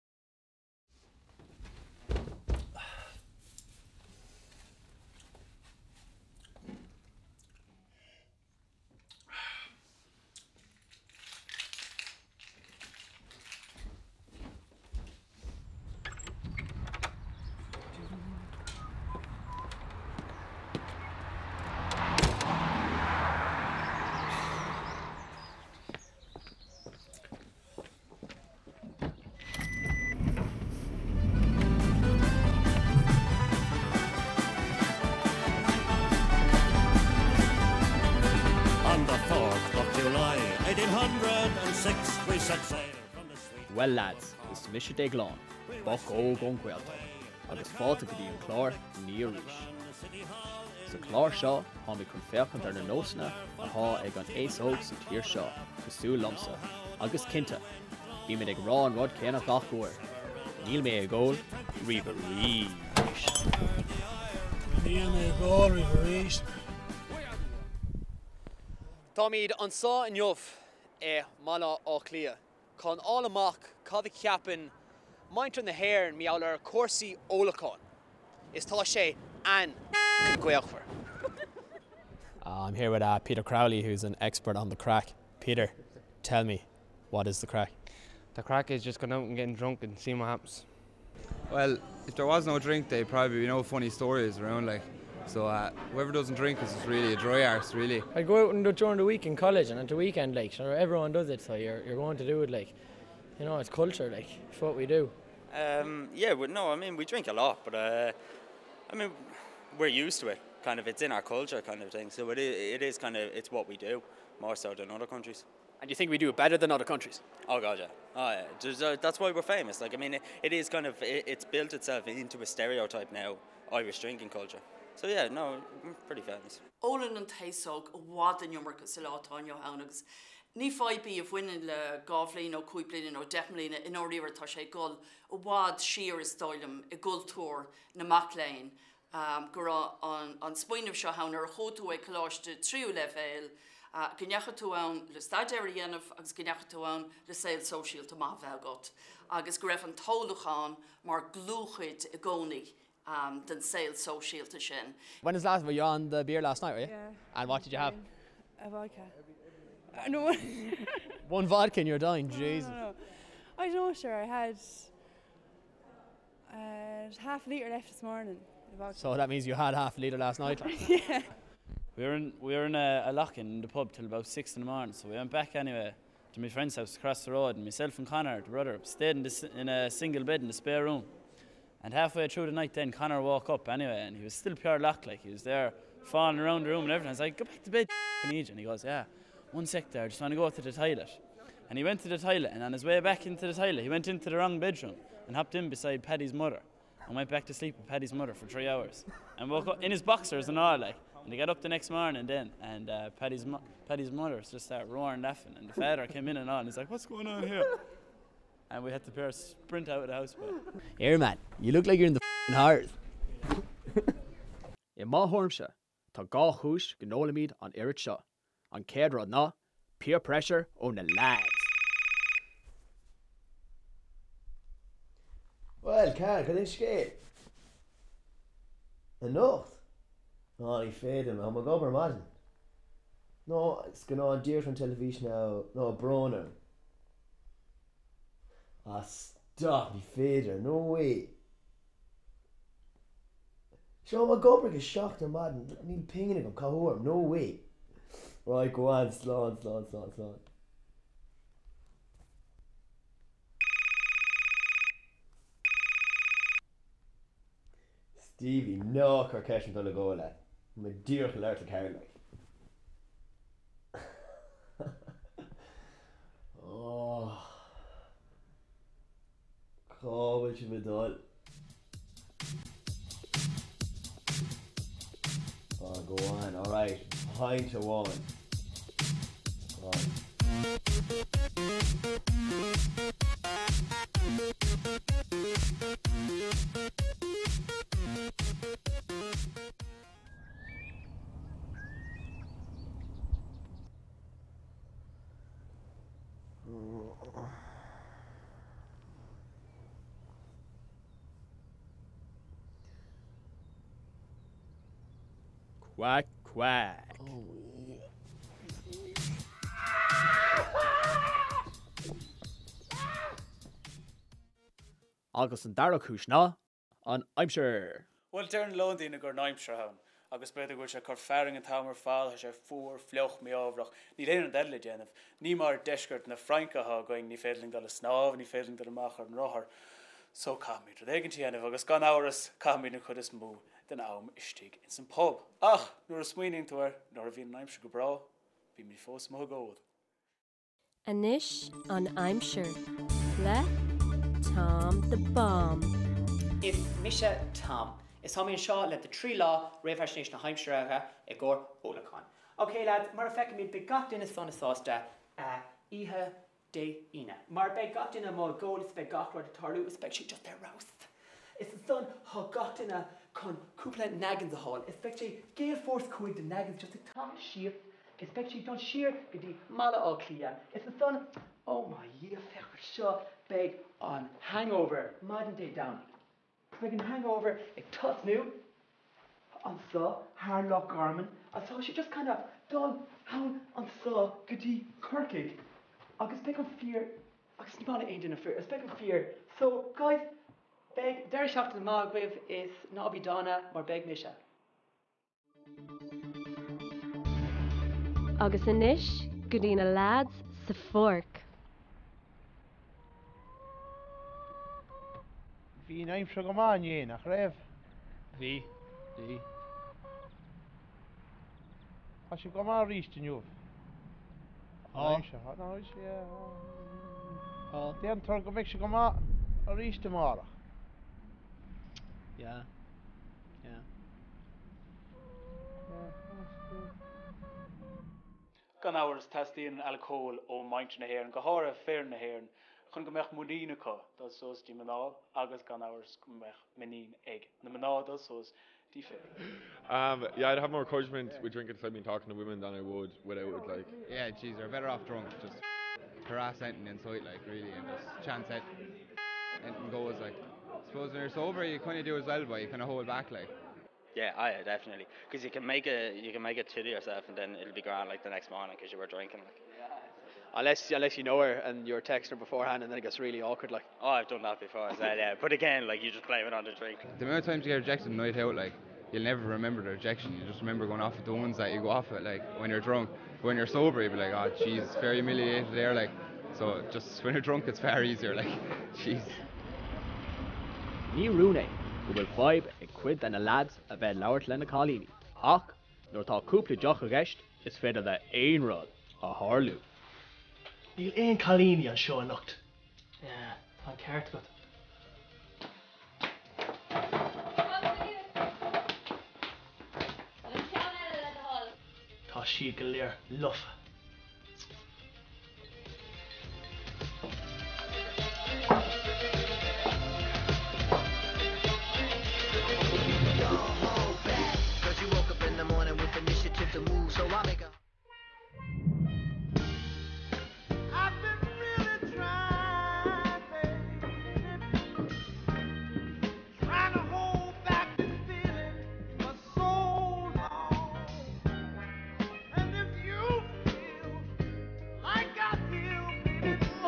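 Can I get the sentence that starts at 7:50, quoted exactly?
You just remember going off at the ones that you go off at, like when you're drunk.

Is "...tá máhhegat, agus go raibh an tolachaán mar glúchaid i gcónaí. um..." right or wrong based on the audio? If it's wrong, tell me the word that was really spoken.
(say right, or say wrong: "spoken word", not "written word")
right.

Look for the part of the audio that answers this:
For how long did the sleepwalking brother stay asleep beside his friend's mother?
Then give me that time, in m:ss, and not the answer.
3:18.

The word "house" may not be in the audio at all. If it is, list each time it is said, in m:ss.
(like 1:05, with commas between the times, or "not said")
2:56, 3:30.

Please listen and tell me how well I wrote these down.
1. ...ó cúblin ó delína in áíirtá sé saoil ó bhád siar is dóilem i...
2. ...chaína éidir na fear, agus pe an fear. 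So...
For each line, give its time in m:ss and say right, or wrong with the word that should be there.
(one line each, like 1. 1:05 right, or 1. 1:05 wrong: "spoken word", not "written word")
1. 2:12 wrong: "ggóil", not "saoil"
2. 6:27 wrong: "níána", not "chaína".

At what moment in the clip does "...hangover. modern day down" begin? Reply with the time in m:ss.
6:14.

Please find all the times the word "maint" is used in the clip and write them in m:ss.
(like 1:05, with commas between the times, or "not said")
1:15, 7:10.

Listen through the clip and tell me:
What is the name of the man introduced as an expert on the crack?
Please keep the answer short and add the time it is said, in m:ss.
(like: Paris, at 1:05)
Peter Crowley, at 1:23.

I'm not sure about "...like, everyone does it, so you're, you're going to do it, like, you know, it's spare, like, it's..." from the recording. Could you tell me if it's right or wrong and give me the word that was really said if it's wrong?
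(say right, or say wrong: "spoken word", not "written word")
wrong: "culture", not "spare".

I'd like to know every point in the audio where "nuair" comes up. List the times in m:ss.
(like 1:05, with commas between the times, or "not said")
5:36, 8:06.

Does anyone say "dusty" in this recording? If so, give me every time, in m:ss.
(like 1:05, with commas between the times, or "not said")
not said.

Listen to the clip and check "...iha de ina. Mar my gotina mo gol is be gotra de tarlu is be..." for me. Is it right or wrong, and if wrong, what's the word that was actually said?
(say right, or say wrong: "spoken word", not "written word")
right.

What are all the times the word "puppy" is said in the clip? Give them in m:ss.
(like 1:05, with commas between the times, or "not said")
not said.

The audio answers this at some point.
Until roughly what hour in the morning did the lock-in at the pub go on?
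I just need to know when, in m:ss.
2:54.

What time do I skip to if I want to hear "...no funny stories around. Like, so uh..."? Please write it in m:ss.
1:33.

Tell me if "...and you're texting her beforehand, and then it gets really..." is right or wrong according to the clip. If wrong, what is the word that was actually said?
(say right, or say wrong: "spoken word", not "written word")
right.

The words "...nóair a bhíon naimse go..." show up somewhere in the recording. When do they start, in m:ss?
5:37.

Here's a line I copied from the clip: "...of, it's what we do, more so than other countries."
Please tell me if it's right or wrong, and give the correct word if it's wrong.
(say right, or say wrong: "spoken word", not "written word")
right.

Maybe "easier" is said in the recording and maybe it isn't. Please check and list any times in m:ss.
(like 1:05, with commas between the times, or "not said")
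7:58.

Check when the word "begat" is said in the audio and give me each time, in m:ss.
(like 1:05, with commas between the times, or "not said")
5:53.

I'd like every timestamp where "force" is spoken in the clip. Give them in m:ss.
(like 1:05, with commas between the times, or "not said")
6:05.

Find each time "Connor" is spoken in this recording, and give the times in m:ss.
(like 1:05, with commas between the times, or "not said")
2:58, 3:02.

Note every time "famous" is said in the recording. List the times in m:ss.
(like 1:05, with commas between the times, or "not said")
1:59, 2:06.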